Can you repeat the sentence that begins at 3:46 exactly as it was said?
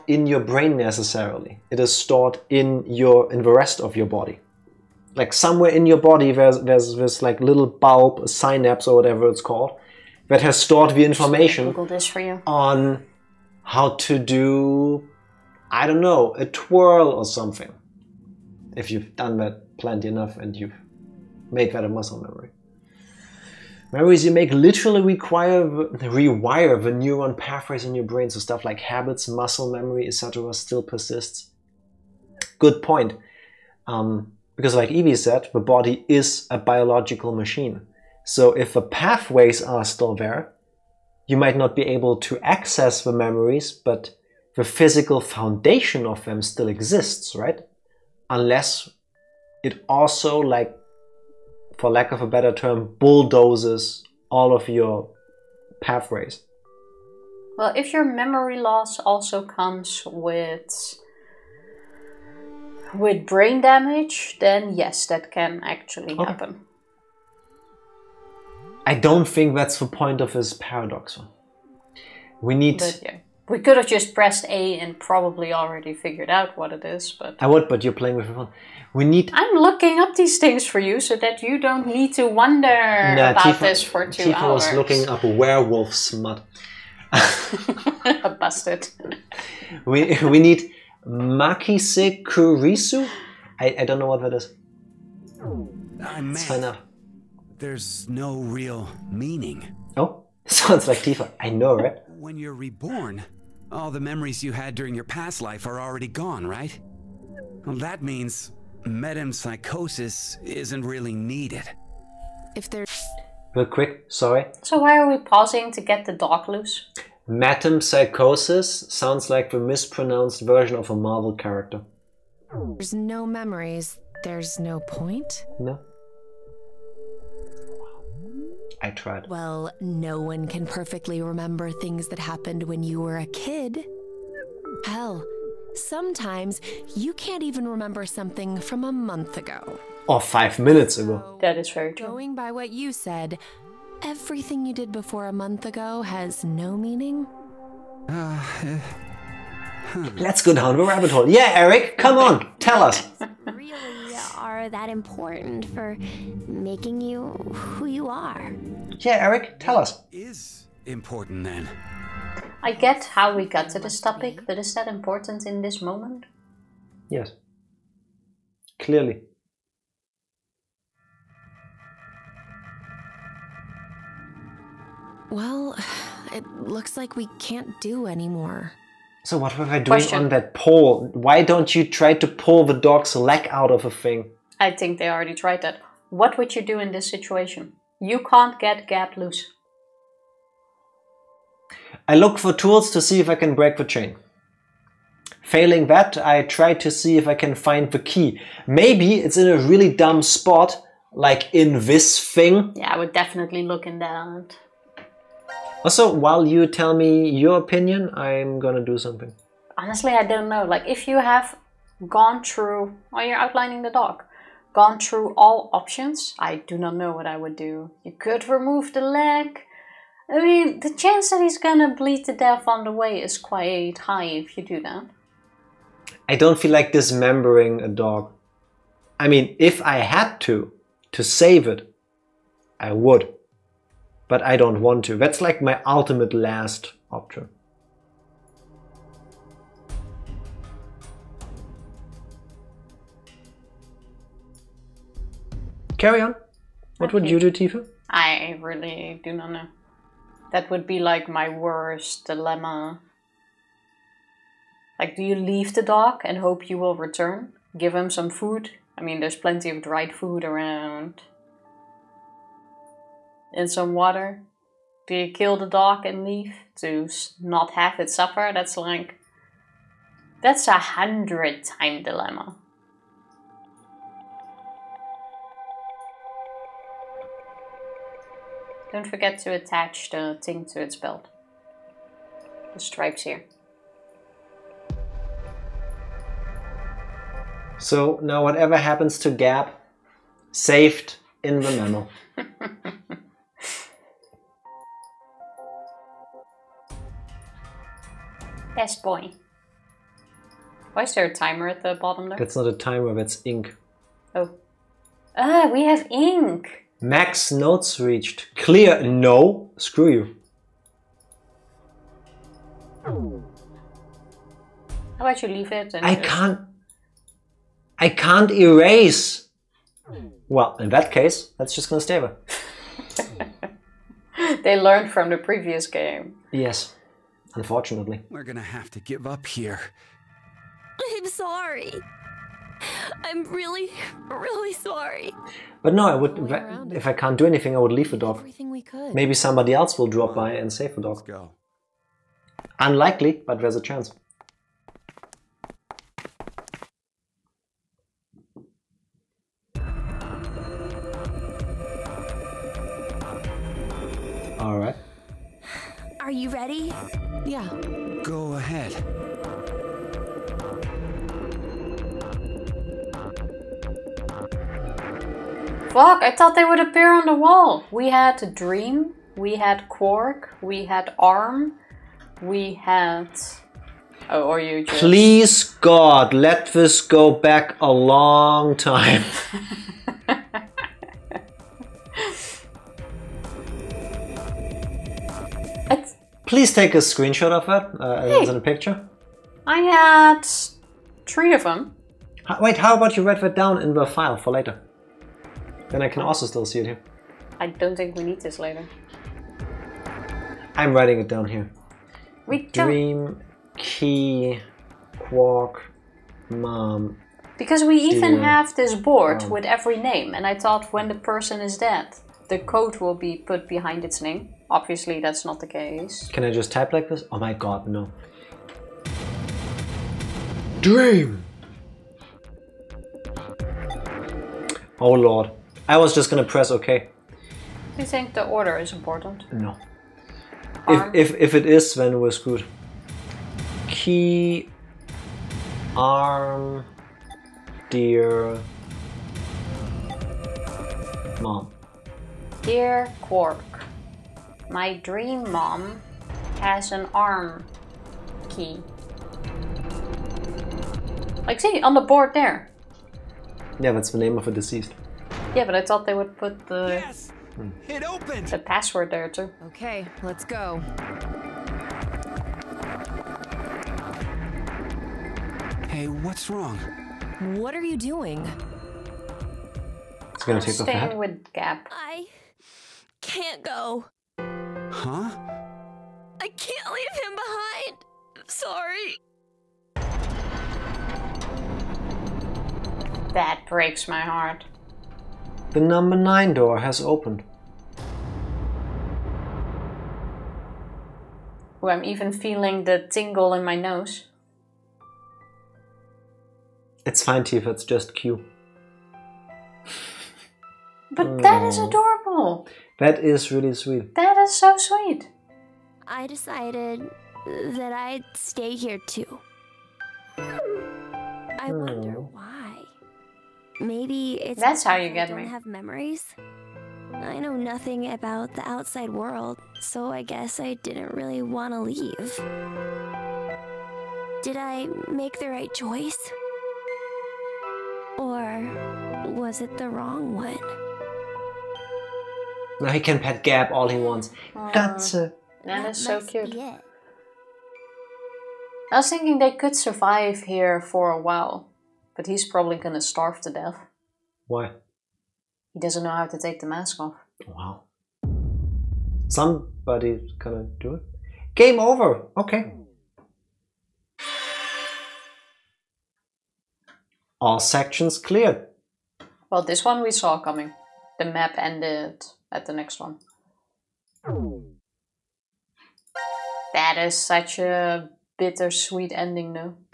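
I don't feel like dismembering a dog.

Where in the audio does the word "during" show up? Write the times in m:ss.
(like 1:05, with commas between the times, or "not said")
1:44.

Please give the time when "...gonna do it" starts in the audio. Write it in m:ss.
9:10.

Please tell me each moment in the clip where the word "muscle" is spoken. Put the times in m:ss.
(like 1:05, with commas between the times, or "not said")
0:21, 0:29.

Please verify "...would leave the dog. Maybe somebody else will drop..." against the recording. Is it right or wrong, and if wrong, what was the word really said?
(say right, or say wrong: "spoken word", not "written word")
right.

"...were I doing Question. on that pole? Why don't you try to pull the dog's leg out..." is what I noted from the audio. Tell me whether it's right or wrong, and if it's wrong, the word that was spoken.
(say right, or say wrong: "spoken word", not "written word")
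right.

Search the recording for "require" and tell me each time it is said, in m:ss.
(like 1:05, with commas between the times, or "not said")
0:25.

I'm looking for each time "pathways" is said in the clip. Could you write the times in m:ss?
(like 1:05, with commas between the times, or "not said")
0:27, 0:38, 0:55.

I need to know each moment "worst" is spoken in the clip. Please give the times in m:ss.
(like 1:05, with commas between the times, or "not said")
4:11.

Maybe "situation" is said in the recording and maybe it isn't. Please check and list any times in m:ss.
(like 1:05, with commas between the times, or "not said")
3:07.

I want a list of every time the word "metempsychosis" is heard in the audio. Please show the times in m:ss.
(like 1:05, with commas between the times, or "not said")
1:48, 1:57.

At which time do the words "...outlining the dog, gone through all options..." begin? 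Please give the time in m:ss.
3:33.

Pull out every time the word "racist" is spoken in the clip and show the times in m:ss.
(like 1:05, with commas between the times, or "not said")
not said.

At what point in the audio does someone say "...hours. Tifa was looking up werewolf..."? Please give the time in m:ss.
1:24.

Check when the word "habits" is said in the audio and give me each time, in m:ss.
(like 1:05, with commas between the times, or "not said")
0:28.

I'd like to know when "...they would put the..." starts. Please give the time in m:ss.
7:36.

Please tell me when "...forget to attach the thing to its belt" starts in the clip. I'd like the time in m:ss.
4:39.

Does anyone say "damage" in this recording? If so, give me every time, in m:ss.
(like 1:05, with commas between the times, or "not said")
1:03.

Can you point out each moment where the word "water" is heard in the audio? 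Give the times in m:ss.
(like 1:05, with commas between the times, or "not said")
4:23.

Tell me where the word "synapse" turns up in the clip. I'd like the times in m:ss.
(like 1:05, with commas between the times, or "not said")
0:08.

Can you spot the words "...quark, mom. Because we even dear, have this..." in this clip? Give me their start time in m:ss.
6:45.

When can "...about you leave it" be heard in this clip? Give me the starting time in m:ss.
5:15.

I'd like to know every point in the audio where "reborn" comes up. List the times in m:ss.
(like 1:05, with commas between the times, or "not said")
1:42.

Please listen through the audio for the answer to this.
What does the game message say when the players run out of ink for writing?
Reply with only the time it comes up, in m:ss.
5:07.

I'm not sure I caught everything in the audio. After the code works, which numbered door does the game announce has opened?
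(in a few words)
9.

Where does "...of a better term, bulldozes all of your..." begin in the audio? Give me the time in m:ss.
0:52.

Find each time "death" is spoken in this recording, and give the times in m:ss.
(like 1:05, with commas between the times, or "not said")
3:42, 9:03.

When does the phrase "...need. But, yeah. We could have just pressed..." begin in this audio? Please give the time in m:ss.
1:12.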